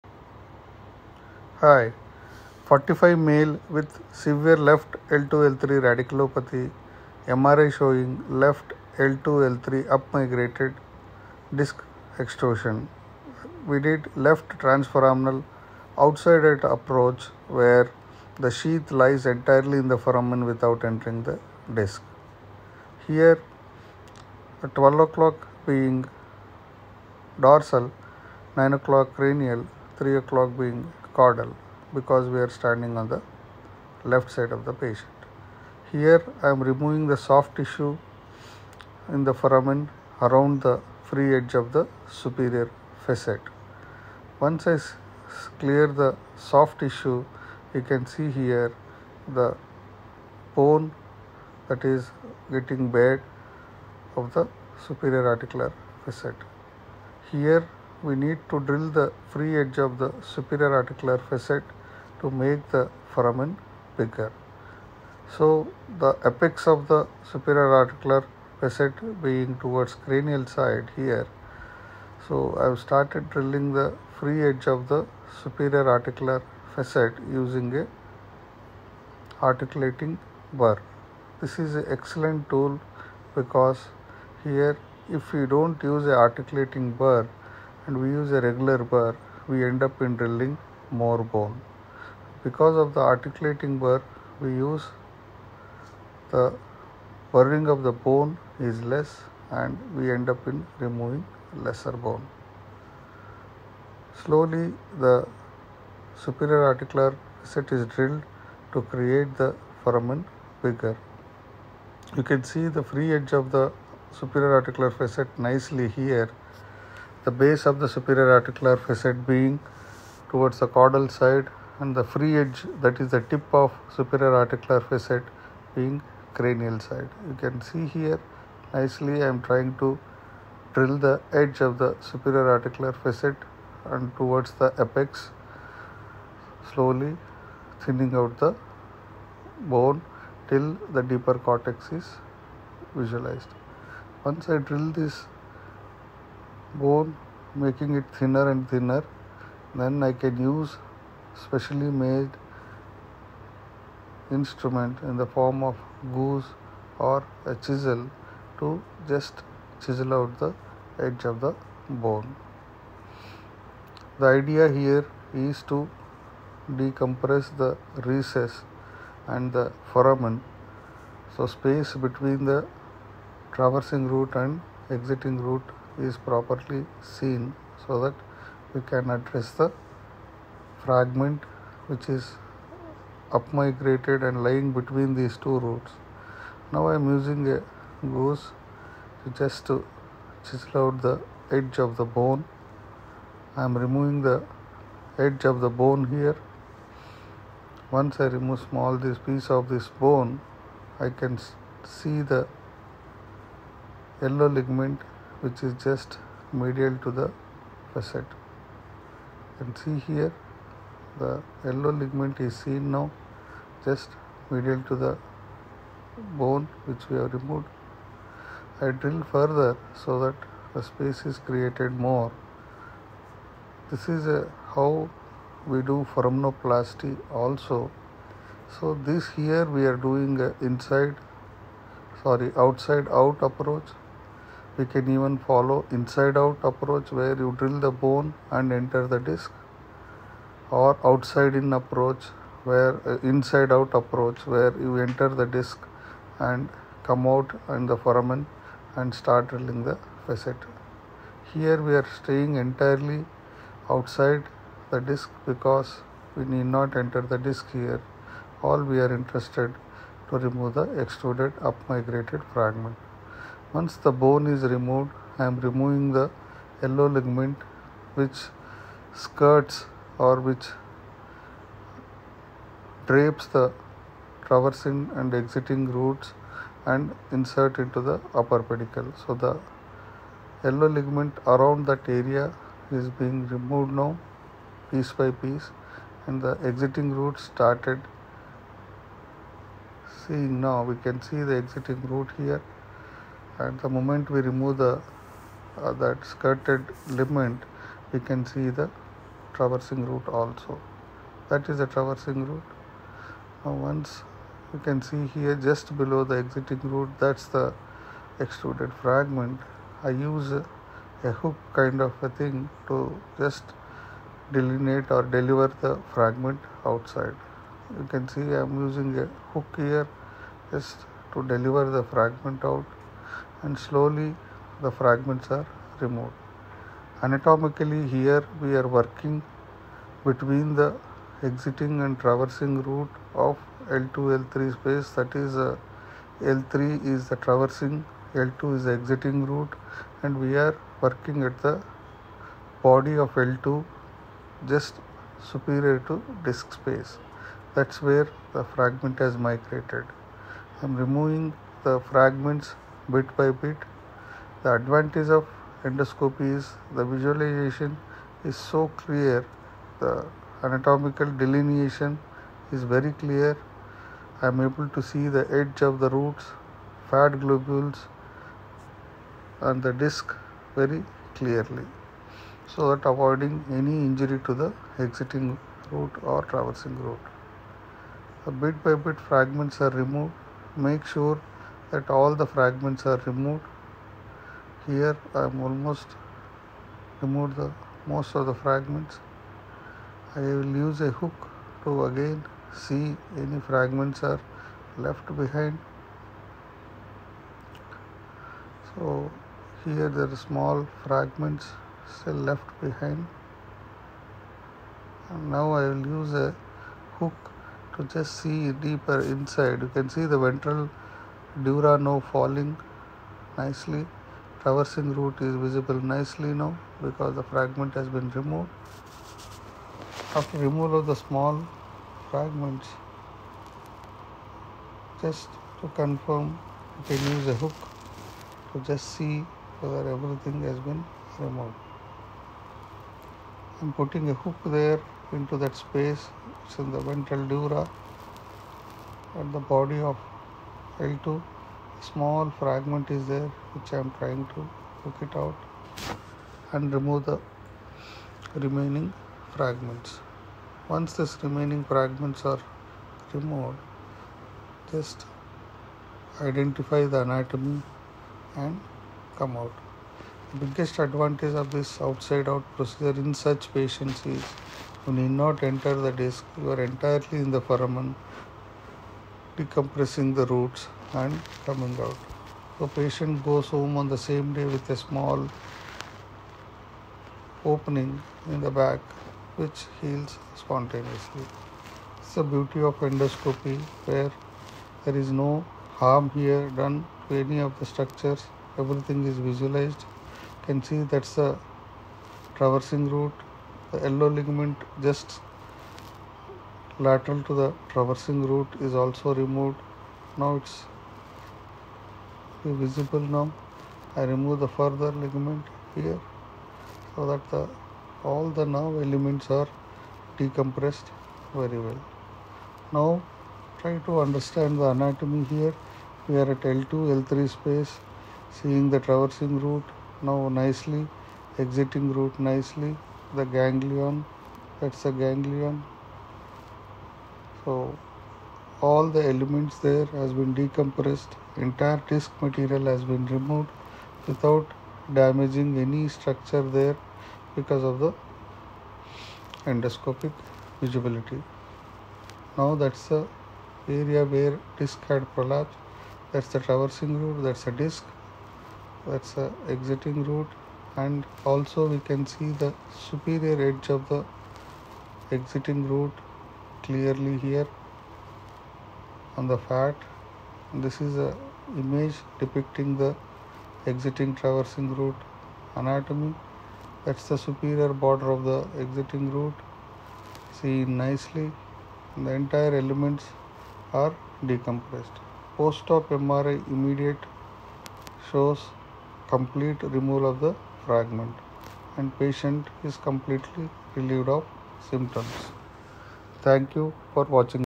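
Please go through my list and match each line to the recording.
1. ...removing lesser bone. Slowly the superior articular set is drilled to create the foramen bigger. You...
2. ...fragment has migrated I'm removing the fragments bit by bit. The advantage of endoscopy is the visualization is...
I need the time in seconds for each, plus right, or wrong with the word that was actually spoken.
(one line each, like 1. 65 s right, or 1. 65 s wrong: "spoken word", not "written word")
1. 100 s right
2. 348 s right.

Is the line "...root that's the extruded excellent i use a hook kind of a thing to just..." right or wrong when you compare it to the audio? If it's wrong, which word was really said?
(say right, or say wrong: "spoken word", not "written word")
wrong: "fragment", not "excellent".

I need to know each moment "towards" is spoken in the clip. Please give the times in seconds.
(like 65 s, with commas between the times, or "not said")
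69 s, 120 s, 134 s.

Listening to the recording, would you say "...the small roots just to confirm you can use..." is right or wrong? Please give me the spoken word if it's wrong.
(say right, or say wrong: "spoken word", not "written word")
wrong: "fragments", not "roots".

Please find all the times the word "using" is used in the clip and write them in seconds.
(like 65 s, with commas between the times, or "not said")
77 s, 187 s, 318 s.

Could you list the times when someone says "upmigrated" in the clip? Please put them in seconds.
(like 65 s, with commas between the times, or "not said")
9 s, 183 s, 261 s.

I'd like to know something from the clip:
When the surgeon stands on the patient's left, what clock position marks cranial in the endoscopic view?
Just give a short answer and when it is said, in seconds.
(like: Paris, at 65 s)
9 o'clock, at 28 s.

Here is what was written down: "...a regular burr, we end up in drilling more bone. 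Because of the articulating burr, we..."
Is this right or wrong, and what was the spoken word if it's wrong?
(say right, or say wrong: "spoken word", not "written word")
right.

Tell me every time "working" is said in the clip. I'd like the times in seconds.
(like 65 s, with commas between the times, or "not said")
328 s, 341 s.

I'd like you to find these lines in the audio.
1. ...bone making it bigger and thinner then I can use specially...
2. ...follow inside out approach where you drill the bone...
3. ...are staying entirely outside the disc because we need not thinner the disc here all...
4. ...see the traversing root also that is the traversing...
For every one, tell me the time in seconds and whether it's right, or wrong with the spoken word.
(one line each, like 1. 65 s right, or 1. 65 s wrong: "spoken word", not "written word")
1. 146 s wrong: "thinner", not "bigger"
2. 235 s right
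3. 252 s wrong: "enter", not "thinner"
4. 298 s right.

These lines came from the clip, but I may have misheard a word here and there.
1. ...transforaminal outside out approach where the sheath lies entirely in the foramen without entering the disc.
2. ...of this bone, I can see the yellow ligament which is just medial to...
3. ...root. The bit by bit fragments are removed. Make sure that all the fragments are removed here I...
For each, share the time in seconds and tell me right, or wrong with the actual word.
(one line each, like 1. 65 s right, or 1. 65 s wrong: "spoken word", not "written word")
1. 14 s right
2. 199 s right
3. 377 s right.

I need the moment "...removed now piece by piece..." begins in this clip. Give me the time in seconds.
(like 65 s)
283 s.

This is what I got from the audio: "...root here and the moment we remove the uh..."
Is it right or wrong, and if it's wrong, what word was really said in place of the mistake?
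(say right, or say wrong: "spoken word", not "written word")
right.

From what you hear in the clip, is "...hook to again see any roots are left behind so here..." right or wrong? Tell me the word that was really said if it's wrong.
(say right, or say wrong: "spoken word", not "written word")
wrong: "fragments", not "roots".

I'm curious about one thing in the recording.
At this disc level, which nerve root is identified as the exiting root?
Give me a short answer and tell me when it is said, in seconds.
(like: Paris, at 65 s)
L2, at 338 s.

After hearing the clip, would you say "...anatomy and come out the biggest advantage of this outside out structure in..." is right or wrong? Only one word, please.
wrong.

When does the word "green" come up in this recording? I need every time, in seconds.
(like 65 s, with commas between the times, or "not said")
not said.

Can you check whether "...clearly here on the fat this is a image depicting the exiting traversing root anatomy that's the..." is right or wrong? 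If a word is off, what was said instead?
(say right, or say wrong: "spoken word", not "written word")
right.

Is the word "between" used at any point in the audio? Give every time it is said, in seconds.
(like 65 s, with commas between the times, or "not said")
171 s, 184 s, 330 s.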